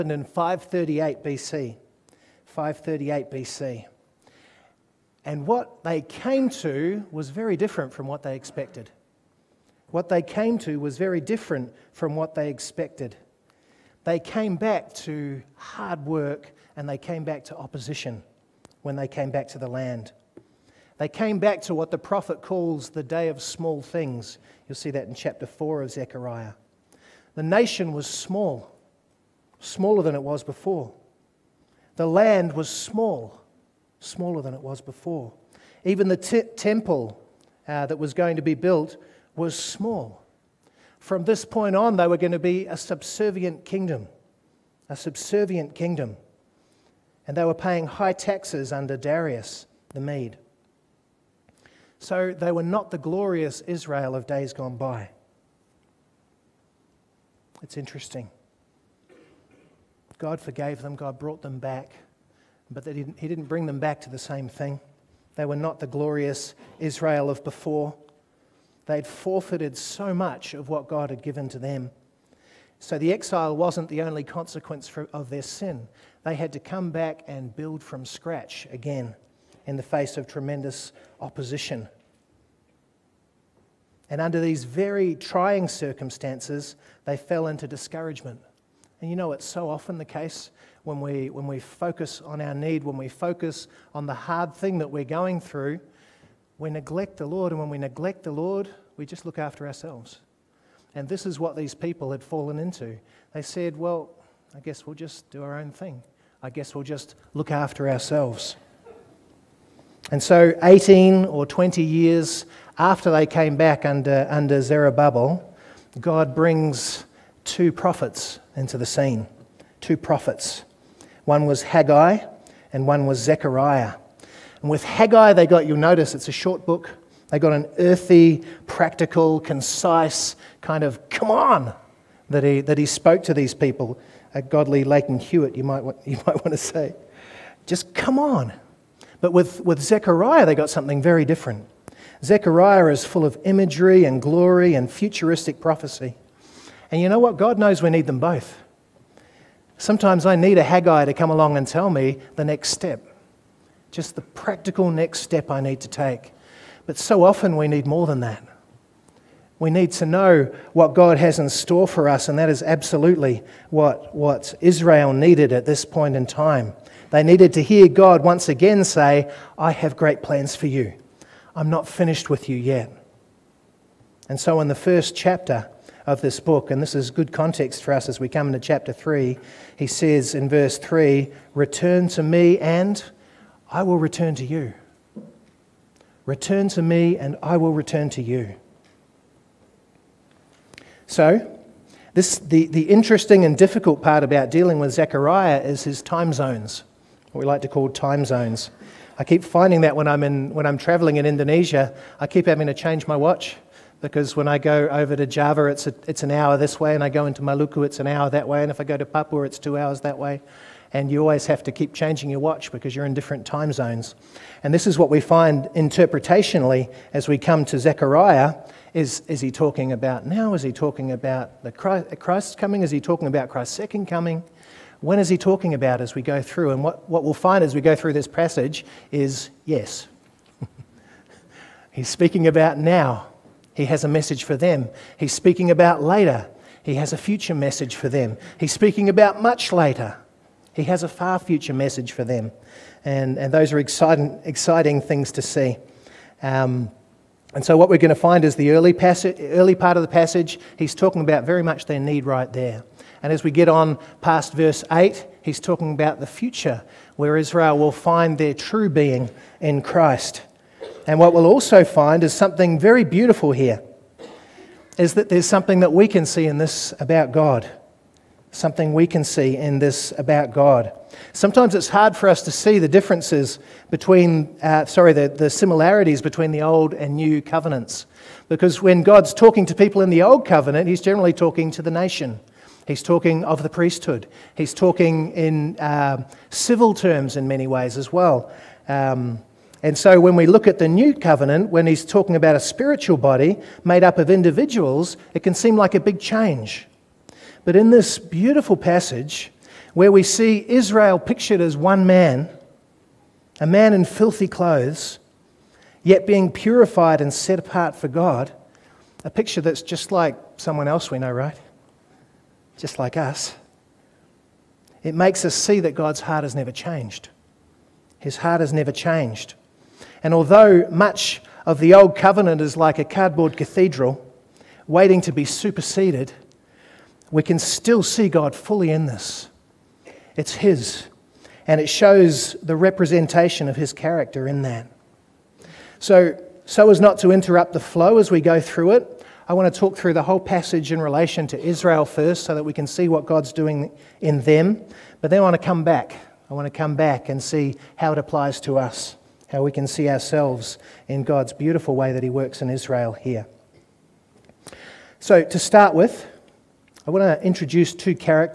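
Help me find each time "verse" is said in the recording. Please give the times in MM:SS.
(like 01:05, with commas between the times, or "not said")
03:00, 04:14.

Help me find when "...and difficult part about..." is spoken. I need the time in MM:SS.
03:13.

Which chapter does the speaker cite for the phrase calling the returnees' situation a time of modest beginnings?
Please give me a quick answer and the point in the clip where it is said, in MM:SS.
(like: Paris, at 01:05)
Chapter 4, at 00:25.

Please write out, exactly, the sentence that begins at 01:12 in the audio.
So the exile wasn't the only consequence for, of their sin.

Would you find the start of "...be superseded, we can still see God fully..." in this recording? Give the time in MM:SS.
05:25.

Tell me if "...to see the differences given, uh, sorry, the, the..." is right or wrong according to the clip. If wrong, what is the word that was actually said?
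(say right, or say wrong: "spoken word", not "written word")
wrong: "between", not "given".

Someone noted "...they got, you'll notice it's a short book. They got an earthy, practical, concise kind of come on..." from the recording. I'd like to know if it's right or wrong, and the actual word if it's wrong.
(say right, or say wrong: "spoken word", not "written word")
right.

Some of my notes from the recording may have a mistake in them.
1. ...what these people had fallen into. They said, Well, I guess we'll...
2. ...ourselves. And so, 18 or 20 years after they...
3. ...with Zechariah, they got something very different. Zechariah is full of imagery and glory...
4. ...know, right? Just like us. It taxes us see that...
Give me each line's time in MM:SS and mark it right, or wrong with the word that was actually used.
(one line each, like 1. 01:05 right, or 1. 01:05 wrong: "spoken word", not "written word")
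1. 01:41 right
2. 01:47 right
3. 02:19 right
4. 05:11 wrong: "makes", not "taxes".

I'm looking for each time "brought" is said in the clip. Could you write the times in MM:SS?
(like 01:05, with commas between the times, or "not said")
01:01.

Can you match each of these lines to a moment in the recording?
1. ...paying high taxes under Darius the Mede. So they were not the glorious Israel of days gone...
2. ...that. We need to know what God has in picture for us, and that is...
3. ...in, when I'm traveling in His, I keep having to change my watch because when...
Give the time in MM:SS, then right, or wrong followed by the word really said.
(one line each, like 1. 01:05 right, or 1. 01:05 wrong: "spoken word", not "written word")
1. 00:47 right
2. 02:38 wrong: "store", not "picture"
3. 03:20 wrong: "Indonesia", not "His".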